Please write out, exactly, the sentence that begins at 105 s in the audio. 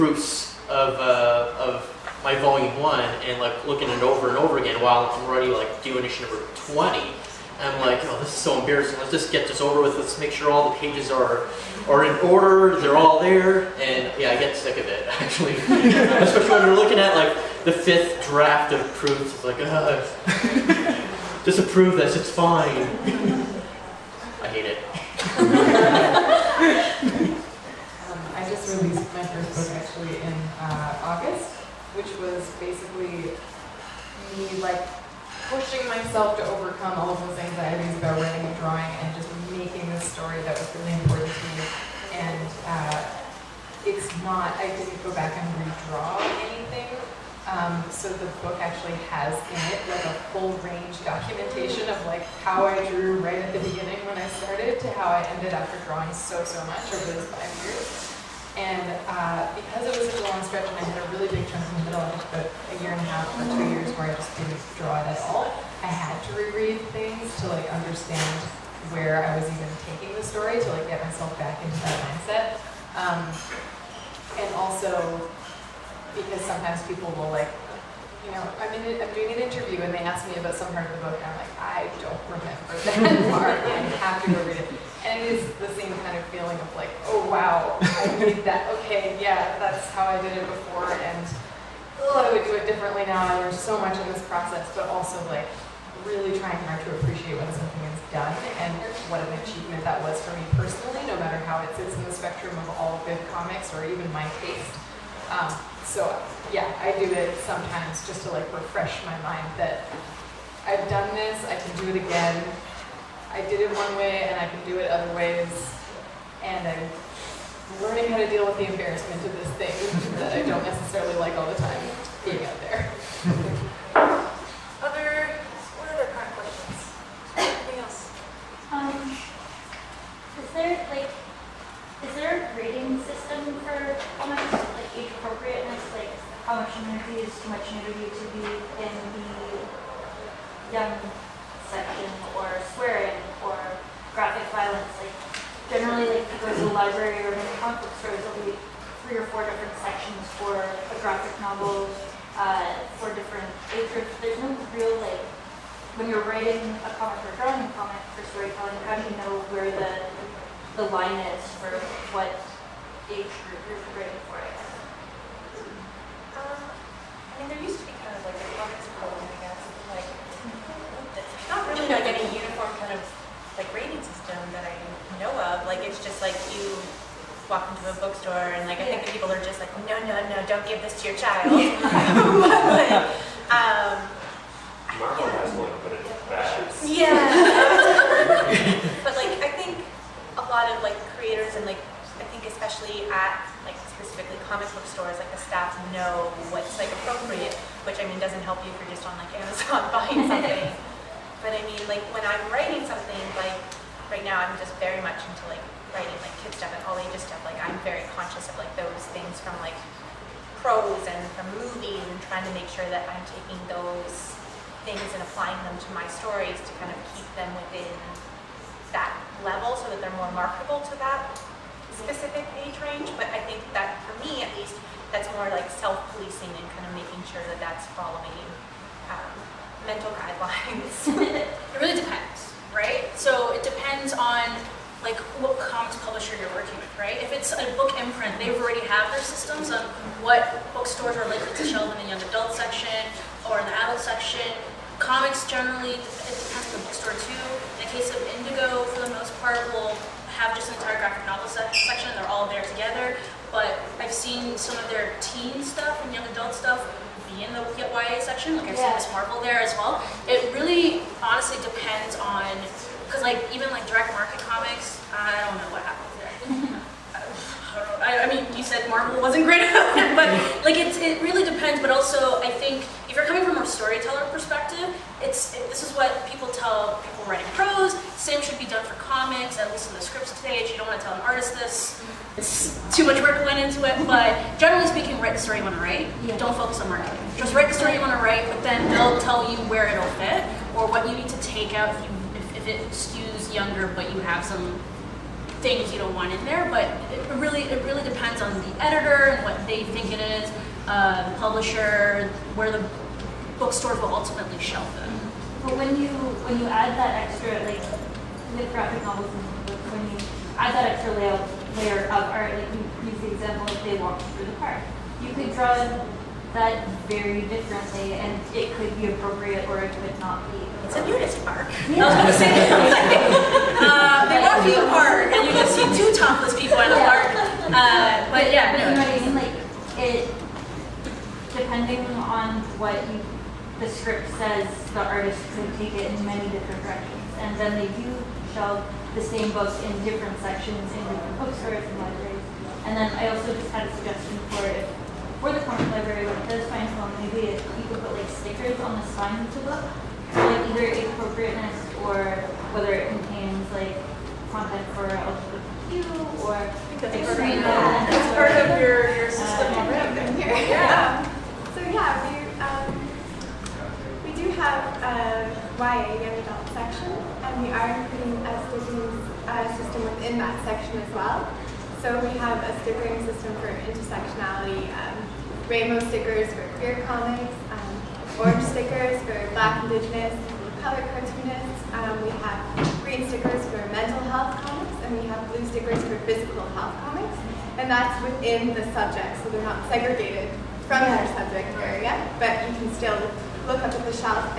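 Um, so yeah, I do it sometimes just to like refresh my mind that I've done this, I can do it again.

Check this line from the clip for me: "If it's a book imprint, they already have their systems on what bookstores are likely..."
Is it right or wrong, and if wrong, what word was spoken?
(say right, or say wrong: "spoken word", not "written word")
right.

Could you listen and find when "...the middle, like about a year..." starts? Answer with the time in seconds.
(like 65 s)
61 s.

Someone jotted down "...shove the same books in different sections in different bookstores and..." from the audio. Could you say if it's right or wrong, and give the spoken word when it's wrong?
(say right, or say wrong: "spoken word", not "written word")
right.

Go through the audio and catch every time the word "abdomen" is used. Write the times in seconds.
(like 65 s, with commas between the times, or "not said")
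not said.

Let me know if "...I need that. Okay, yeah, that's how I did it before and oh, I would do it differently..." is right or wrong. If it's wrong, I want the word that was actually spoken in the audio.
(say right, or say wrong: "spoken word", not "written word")
right.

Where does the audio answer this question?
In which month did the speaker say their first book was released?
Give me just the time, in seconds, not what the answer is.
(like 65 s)
31 s.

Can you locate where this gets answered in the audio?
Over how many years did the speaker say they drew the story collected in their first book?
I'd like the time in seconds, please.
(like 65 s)
57 s.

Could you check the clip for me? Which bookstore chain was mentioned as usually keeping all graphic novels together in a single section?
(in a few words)
Indigo.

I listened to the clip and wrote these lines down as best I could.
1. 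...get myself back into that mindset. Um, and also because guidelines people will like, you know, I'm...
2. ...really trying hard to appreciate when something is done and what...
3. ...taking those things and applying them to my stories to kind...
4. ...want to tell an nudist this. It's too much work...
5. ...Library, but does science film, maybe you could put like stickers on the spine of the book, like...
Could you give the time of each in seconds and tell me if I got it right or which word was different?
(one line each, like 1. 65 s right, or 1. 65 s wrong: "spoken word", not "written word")
1. 70 s wrong: "sometimes", not "guidelines"
2. 96 s right
3. 213 s right
4. 280 s wrong: "artist", not "nudist"
5. 345 s right.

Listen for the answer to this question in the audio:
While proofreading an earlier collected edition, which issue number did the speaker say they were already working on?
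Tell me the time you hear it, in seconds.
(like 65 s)
6 s.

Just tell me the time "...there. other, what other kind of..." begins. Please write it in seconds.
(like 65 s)
122 s.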